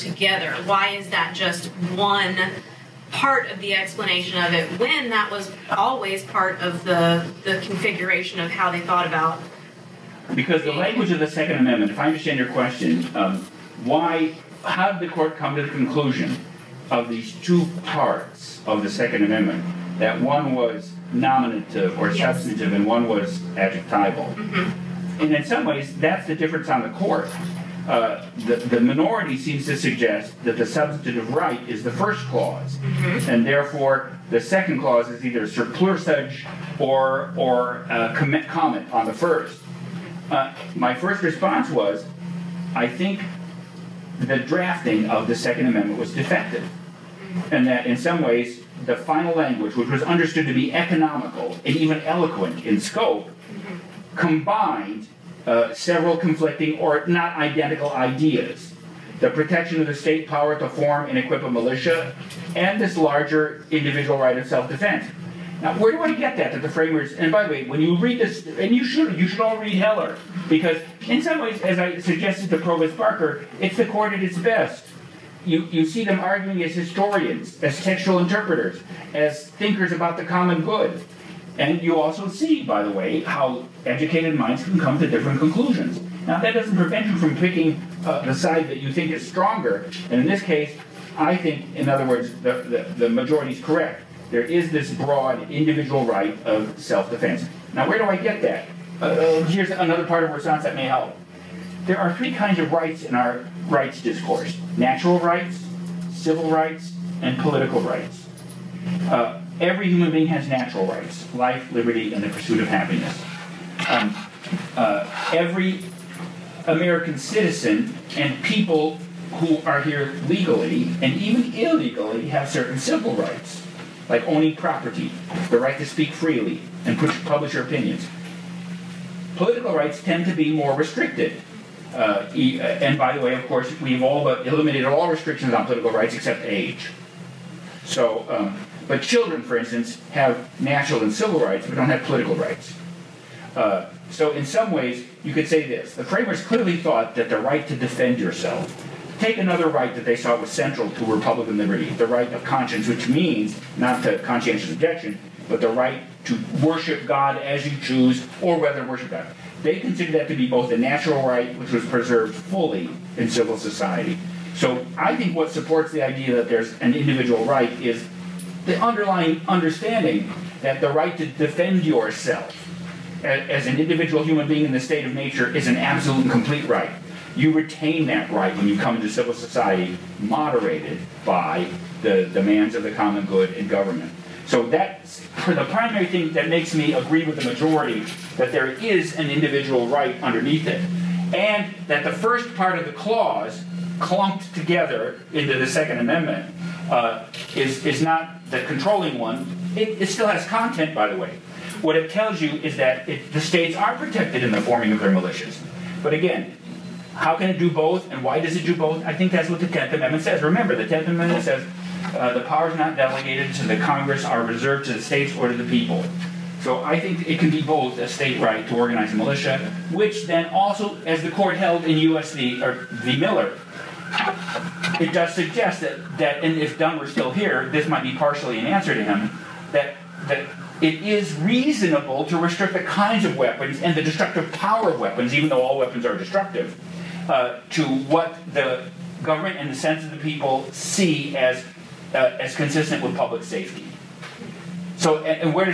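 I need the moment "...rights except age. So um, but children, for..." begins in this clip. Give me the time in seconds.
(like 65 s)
135 s.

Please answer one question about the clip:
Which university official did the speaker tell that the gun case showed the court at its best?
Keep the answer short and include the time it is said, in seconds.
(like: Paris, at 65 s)
Provost Barker, at 72 s.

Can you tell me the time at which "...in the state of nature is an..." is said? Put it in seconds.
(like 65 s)
174 s.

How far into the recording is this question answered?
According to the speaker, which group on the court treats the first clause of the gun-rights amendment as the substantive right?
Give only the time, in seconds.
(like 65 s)
28 s.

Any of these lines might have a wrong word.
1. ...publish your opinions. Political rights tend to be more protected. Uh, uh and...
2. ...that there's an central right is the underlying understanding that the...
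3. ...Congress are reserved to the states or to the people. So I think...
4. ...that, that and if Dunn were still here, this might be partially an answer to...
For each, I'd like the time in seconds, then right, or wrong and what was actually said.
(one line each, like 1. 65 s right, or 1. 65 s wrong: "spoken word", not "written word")
1. 127 s wrong: "restricted", not "protected"
2. 166 s wrong: "individual", not "central"
3. 213 s right
4. 225 s right.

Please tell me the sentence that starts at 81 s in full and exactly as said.
And you also see, by the way, how educated minds can come to different conclusions.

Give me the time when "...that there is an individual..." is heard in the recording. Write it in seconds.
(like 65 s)
188 s.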